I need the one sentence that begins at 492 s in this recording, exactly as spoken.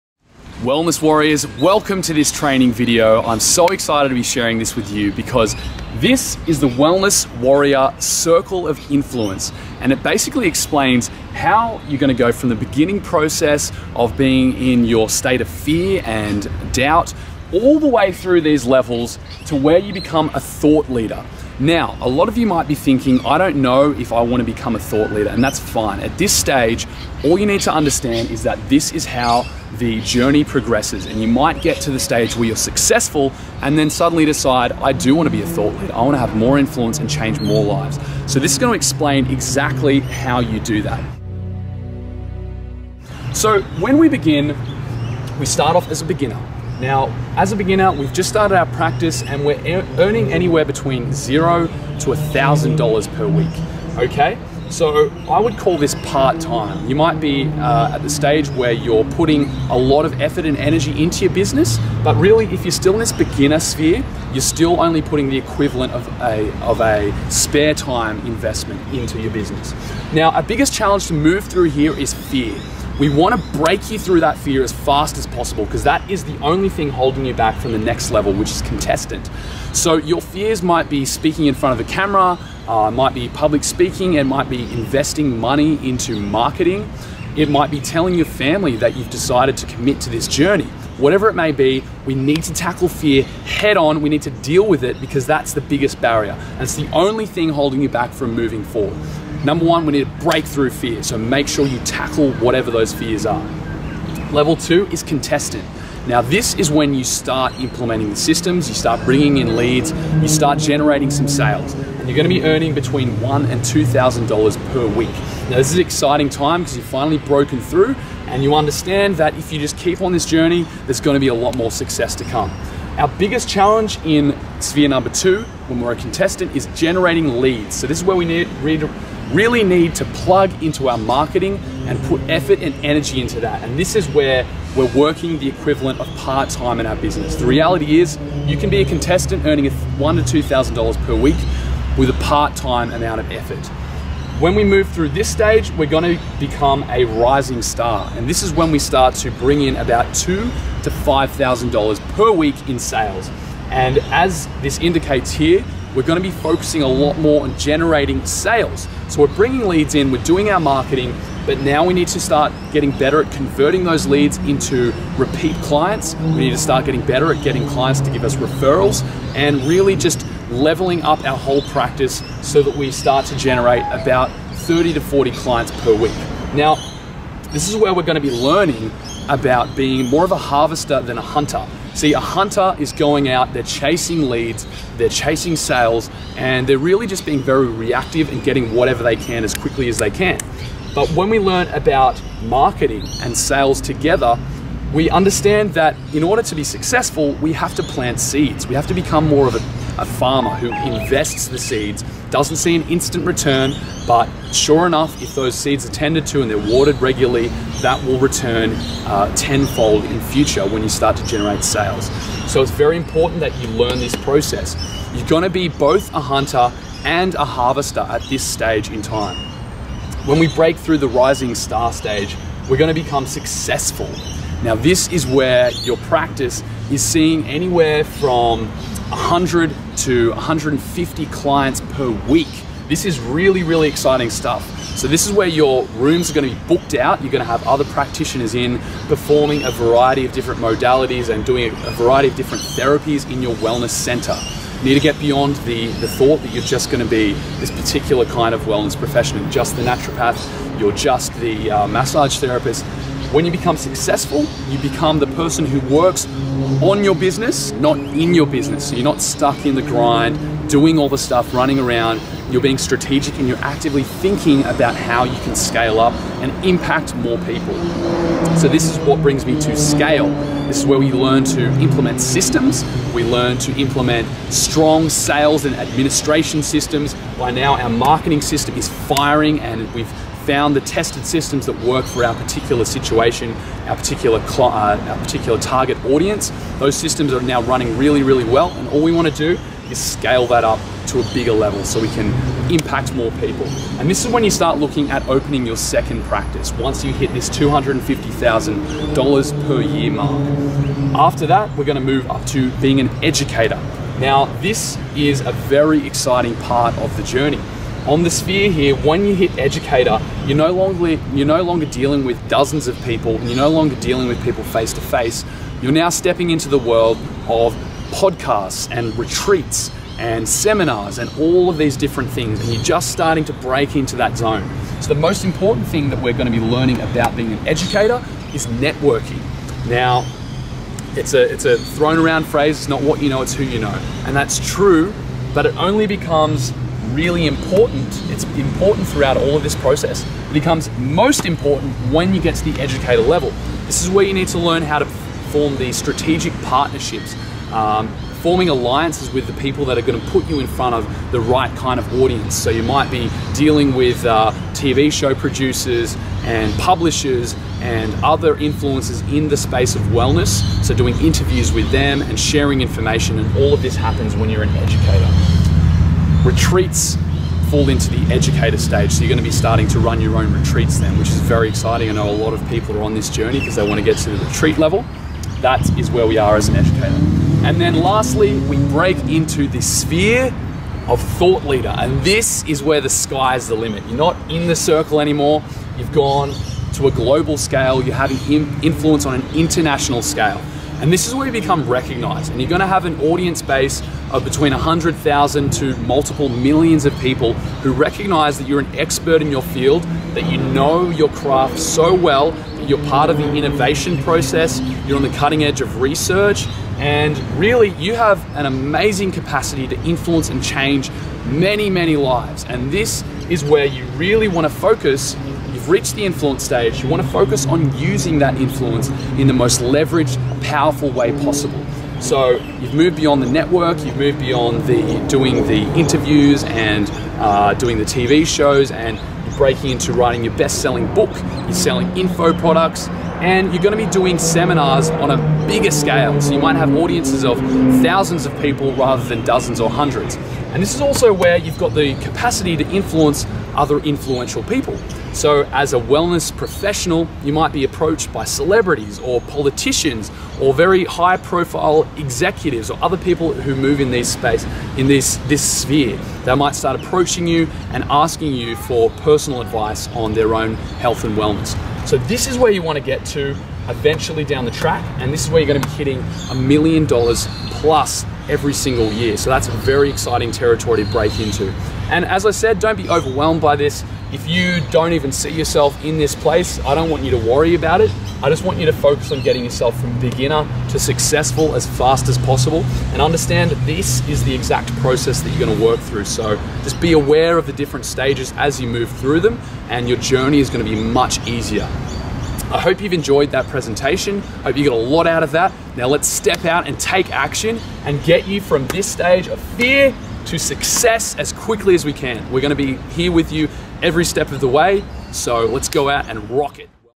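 I hope you've enjoyed that presentation.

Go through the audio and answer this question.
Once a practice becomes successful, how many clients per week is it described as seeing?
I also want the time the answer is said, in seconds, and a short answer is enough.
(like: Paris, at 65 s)
100 to 150, at 229 s.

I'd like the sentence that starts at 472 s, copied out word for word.
And as I said, don't be overwhelmed by this.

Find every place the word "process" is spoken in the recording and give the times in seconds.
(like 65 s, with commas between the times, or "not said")
13 s, 214 s, 339 s, 404 s, 484 s.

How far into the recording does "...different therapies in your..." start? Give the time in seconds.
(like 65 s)
242 s.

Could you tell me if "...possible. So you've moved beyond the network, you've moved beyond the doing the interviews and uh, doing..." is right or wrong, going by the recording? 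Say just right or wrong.
right.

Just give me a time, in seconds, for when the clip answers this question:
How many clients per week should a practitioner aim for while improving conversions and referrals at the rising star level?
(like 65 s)
174 s.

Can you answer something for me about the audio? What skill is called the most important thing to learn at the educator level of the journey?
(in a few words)
networking.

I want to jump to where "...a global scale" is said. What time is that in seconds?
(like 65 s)
387 s.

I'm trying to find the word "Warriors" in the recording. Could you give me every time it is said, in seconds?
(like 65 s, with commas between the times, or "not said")
1 s, 7 s.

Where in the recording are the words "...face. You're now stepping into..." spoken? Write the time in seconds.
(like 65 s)
315 s.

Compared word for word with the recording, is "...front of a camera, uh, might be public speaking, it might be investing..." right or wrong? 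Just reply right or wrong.
right.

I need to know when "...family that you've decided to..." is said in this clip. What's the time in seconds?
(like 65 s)
88 s.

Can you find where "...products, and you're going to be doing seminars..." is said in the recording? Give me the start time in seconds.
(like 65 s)
432 s.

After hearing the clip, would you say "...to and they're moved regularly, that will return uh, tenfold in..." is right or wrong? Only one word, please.
wrong.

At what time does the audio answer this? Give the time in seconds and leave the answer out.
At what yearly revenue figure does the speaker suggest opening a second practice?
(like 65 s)
297 s.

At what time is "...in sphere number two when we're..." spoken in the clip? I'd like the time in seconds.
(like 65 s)
124 s.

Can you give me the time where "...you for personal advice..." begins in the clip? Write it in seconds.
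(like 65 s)
458 s.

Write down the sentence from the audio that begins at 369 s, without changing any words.
So you're going to be starting to run your own retreats then, which is very exciting.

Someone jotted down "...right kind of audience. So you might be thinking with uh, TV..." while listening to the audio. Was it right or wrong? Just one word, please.
wrong.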